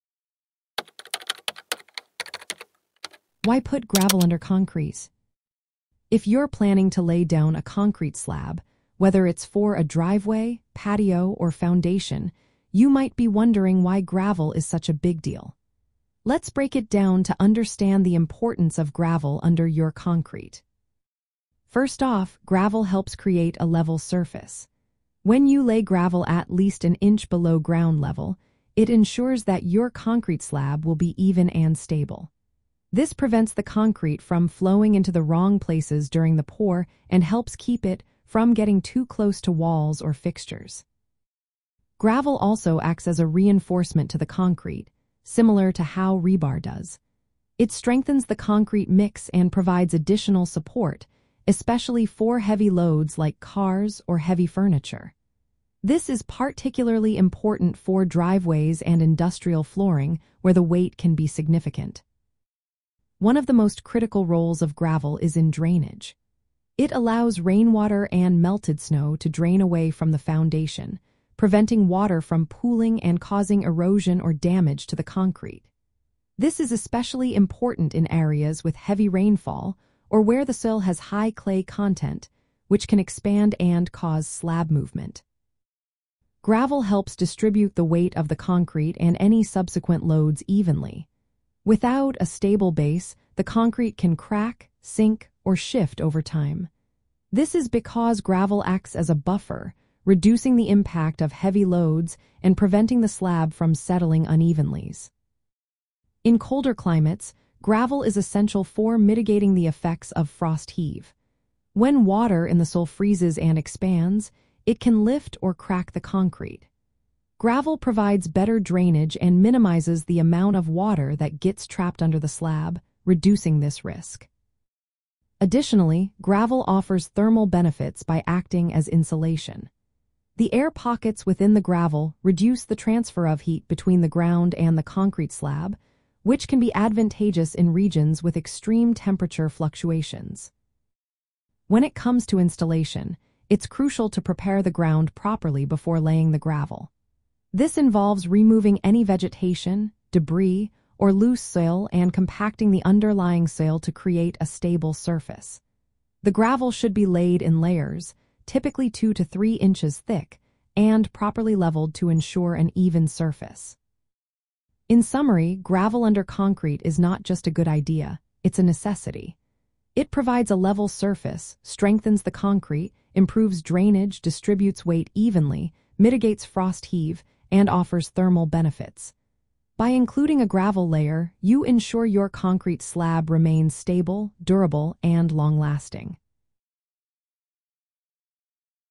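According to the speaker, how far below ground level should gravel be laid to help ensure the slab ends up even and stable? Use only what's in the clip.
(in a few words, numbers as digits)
at least an inch.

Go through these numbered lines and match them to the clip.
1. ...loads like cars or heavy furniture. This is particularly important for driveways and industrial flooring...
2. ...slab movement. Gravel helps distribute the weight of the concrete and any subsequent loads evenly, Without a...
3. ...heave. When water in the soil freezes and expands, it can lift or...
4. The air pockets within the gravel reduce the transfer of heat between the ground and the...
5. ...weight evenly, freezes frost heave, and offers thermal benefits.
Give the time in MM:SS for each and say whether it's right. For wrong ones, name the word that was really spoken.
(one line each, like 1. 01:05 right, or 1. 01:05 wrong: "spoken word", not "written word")
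1. 00:52 right
2. 01:24 right
3. 01:50 right
4. 02:10 right
5. 02:54 wrong: "mitigates", not "freezes".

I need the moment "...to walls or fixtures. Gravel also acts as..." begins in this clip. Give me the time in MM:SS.
00:39.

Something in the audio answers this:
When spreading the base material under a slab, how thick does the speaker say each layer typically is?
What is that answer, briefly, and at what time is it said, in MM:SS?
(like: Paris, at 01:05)
2 to 3 inches, at 02:38.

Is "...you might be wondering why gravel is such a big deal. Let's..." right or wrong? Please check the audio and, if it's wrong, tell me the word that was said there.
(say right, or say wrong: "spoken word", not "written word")
right.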